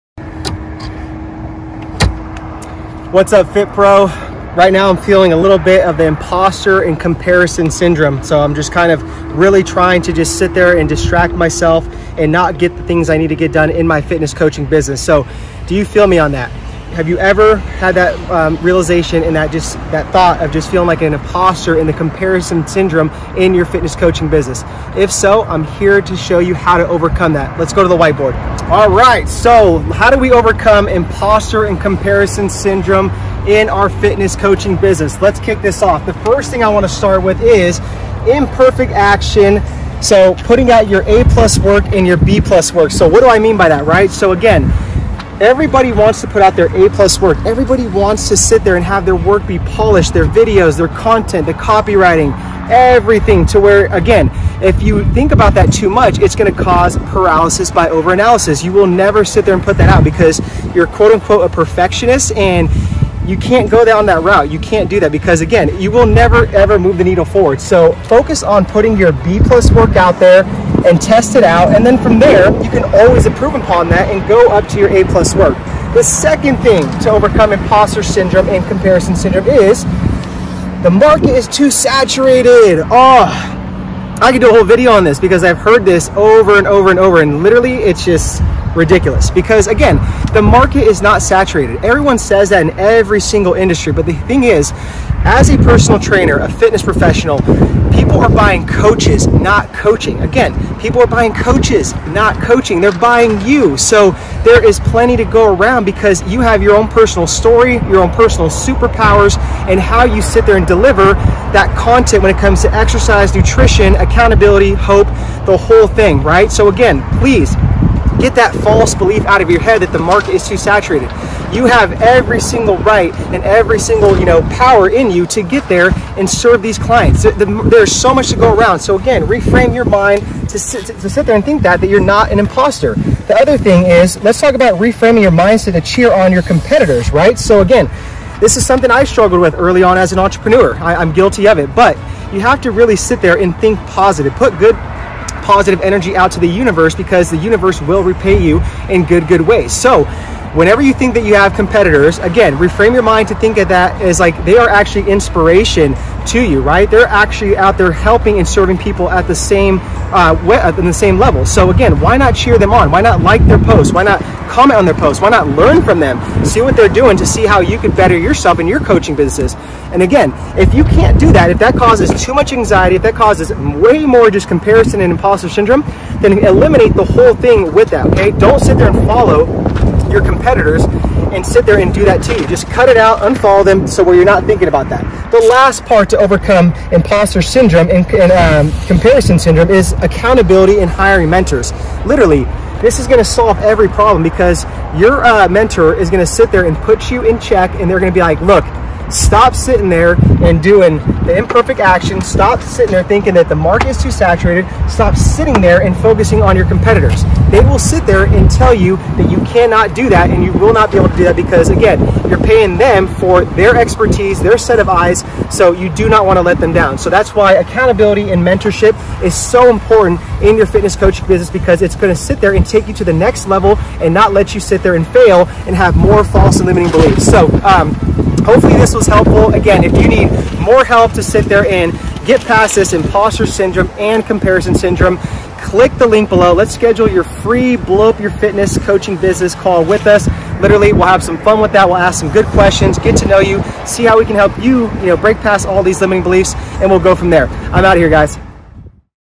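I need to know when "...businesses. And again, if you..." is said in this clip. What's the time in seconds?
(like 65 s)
169 s.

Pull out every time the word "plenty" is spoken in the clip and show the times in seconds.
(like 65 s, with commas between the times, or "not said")
104 s.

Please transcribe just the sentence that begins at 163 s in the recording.
Why not comment on their posts?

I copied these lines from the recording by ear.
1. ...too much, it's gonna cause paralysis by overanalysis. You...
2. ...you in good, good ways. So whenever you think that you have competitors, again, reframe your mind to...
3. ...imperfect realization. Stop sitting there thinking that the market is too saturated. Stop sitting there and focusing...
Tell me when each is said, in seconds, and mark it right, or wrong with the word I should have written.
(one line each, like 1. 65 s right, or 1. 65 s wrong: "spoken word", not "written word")
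1. 55 s right
2. 148 s right
3. 201 s wrong: "action", not "realization".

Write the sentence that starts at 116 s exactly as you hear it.
So, again, please Get that false belief out of your head that the market is too saturated.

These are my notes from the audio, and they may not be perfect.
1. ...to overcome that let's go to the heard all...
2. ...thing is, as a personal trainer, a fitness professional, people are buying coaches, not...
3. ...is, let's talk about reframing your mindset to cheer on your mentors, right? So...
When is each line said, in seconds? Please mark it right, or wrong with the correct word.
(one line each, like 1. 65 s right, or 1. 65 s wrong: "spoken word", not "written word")
1. 26 s wrong: "whiteboard", not "heard"
2. 94 s right
3. 133 s wrong: "competitors", not "mentors".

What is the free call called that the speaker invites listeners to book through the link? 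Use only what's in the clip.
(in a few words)
Blow up your fitness coaching business call.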